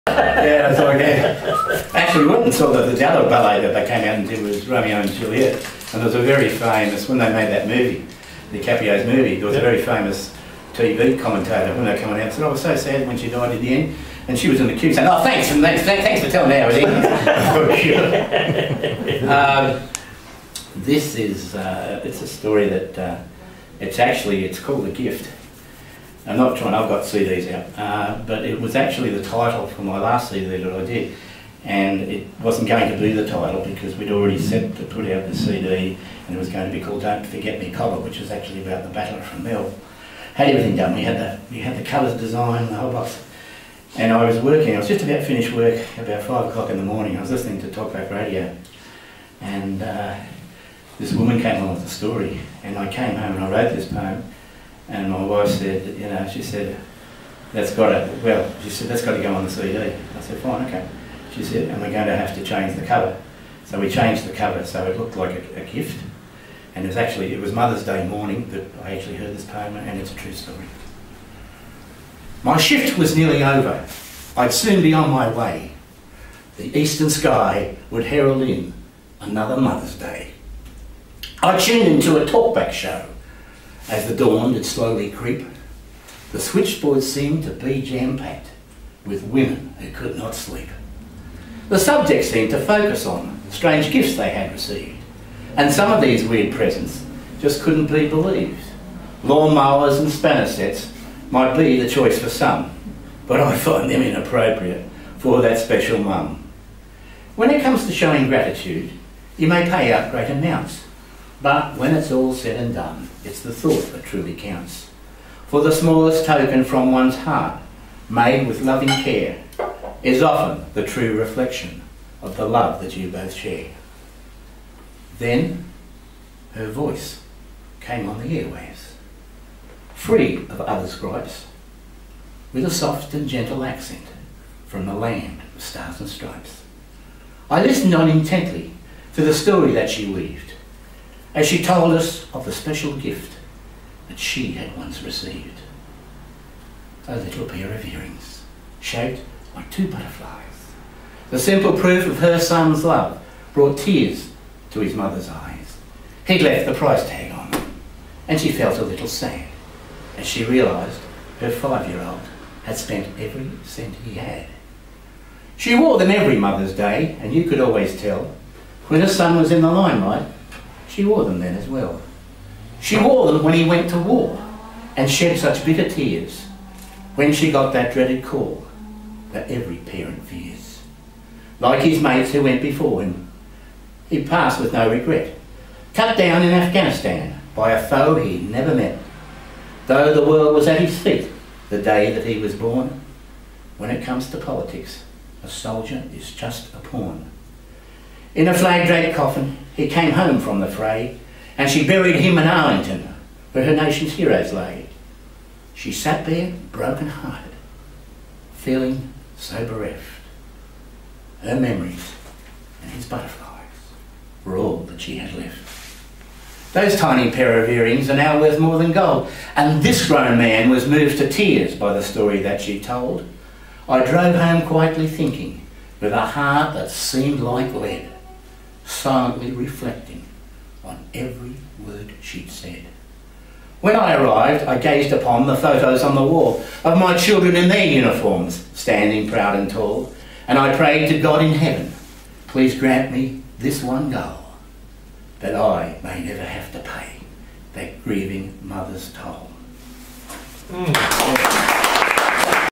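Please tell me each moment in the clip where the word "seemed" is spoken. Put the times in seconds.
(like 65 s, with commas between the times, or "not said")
87 s, 92 s, 226 s.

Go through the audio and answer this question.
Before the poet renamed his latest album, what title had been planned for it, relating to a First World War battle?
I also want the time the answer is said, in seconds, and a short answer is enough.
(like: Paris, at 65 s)
Don't Forget Me Cobber, at 37 s.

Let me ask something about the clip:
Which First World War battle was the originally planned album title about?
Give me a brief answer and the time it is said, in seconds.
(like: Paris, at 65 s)
Fromelles, at 39 s.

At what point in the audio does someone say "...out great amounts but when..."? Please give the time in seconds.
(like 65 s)
109 s.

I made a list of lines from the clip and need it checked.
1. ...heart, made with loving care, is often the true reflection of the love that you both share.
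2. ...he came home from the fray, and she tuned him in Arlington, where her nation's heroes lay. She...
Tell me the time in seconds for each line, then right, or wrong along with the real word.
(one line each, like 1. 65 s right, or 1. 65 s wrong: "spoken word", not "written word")
1. 117 s right
2. 199 s wrong: "buried", not "tuned".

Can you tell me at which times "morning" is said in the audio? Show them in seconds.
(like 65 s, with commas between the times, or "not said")
46 s, 68 s.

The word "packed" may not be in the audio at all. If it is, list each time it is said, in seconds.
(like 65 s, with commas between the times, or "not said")
87 s.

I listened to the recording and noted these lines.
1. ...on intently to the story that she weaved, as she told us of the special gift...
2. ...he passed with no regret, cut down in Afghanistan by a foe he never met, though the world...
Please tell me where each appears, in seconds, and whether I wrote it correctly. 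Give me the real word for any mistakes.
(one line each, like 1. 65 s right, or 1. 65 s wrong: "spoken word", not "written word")
1. 137 s right
2. 184 s right.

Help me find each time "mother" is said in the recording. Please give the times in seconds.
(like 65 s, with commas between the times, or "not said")
67 s, 79 s, 154 s, 166 s, 248 s.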